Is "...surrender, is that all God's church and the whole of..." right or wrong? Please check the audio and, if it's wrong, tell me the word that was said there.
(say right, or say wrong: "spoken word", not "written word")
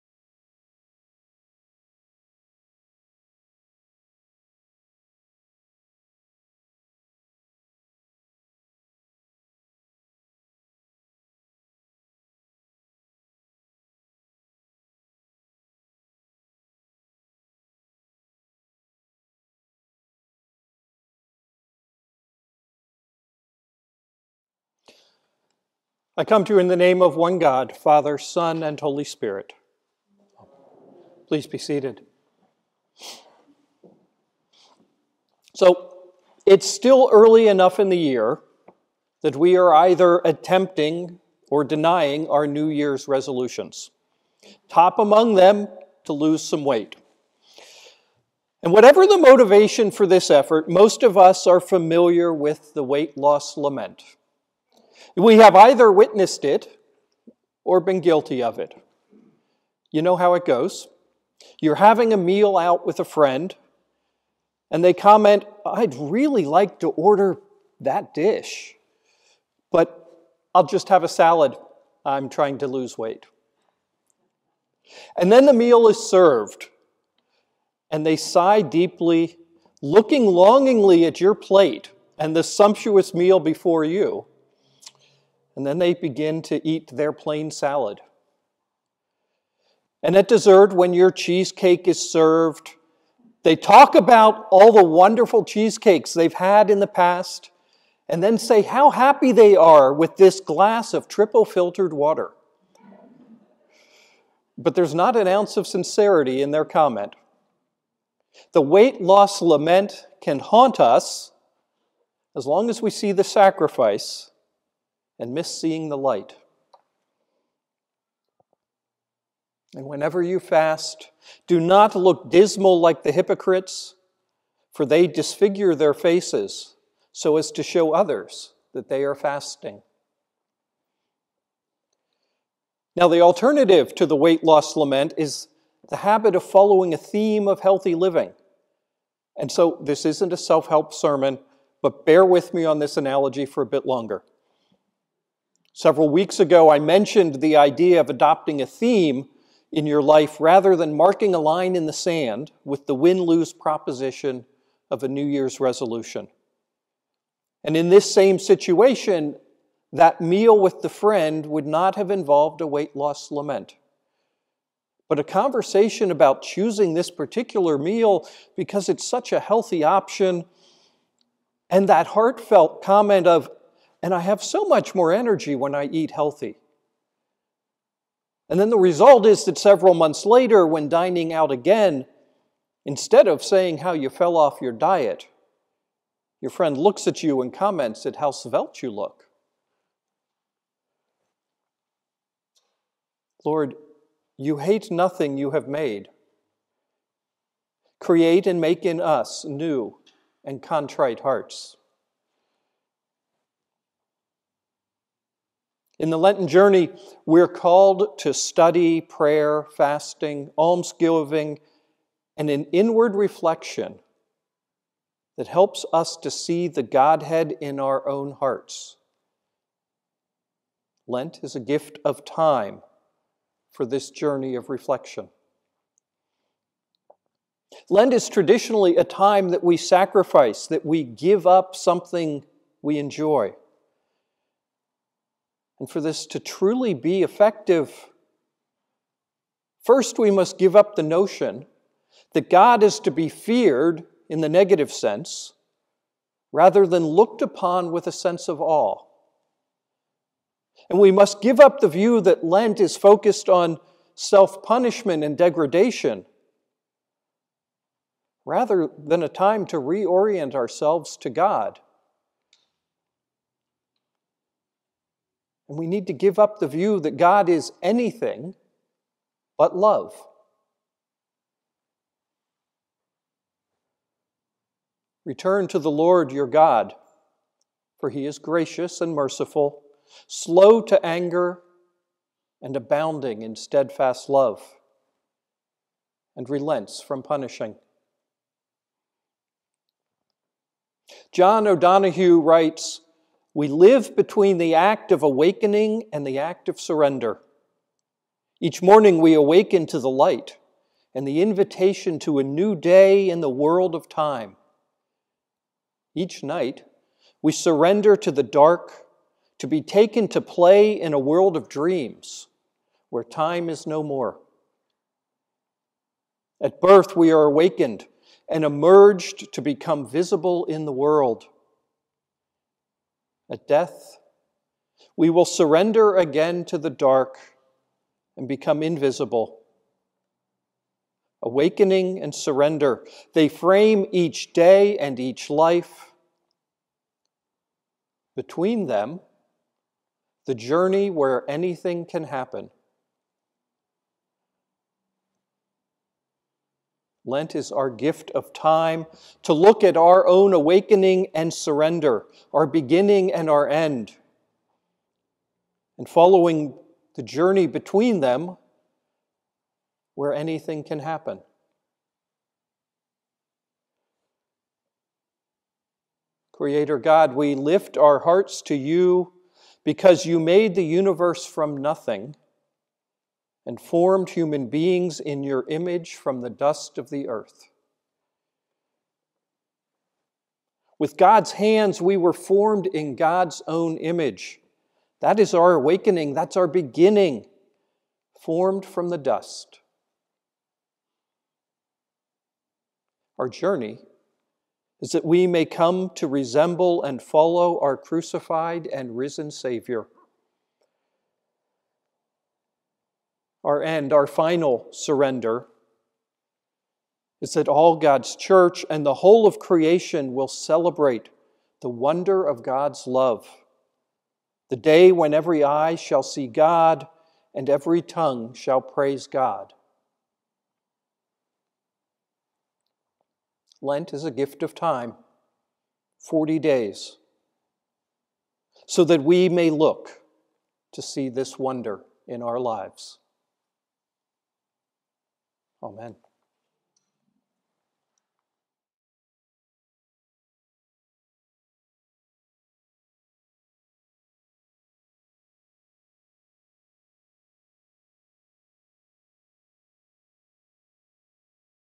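right.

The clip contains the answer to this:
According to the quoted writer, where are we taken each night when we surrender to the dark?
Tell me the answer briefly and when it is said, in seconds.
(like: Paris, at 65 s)
A world of dreams, at 311 s.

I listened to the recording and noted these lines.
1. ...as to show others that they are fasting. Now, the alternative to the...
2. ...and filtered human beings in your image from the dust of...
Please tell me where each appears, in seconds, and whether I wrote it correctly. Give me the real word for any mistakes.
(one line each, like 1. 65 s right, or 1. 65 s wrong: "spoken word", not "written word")
1. 127 s right
2. 373 s wrong: "formed", not "filtered".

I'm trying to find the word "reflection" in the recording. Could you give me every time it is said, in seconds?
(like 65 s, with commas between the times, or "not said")
213 s, 224 s.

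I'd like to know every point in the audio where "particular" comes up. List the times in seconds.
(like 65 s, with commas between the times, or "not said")
167 s.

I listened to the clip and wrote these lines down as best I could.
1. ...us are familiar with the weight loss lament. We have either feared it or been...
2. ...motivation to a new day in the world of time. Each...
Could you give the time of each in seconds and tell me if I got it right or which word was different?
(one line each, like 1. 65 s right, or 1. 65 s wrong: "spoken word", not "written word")
1. 51 s wrong: "witnessed", not "feared"
2. 301 s wrong: "invitation", not "motivation".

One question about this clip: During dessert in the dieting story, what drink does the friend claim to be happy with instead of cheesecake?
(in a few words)
Triple filtered water.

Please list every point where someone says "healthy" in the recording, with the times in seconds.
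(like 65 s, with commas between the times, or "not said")
137 s, 169 s, 176 s.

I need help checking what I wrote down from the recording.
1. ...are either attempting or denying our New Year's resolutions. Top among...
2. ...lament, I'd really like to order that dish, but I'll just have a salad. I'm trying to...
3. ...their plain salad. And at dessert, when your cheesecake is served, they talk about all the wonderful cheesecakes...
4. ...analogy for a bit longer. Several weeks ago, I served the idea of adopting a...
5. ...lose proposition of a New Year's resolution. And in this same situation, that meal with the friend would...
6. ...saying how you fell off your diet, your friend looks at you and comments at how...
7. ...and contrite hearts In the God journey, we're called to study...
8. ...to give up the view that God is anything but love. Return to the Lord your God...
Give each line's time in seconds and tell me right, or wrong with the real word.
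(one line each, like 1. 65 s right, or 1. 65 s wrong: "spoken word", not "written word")
1. 39 s right
2. 64 s wrong: "comment", not "lament"
3. 86 s right
4. 142 s wrong: "mentioned", not "served"
5. 153 s right
6. 183 s right
7. 200 s wrong: "Lenten", not "God"
8. 266 s right.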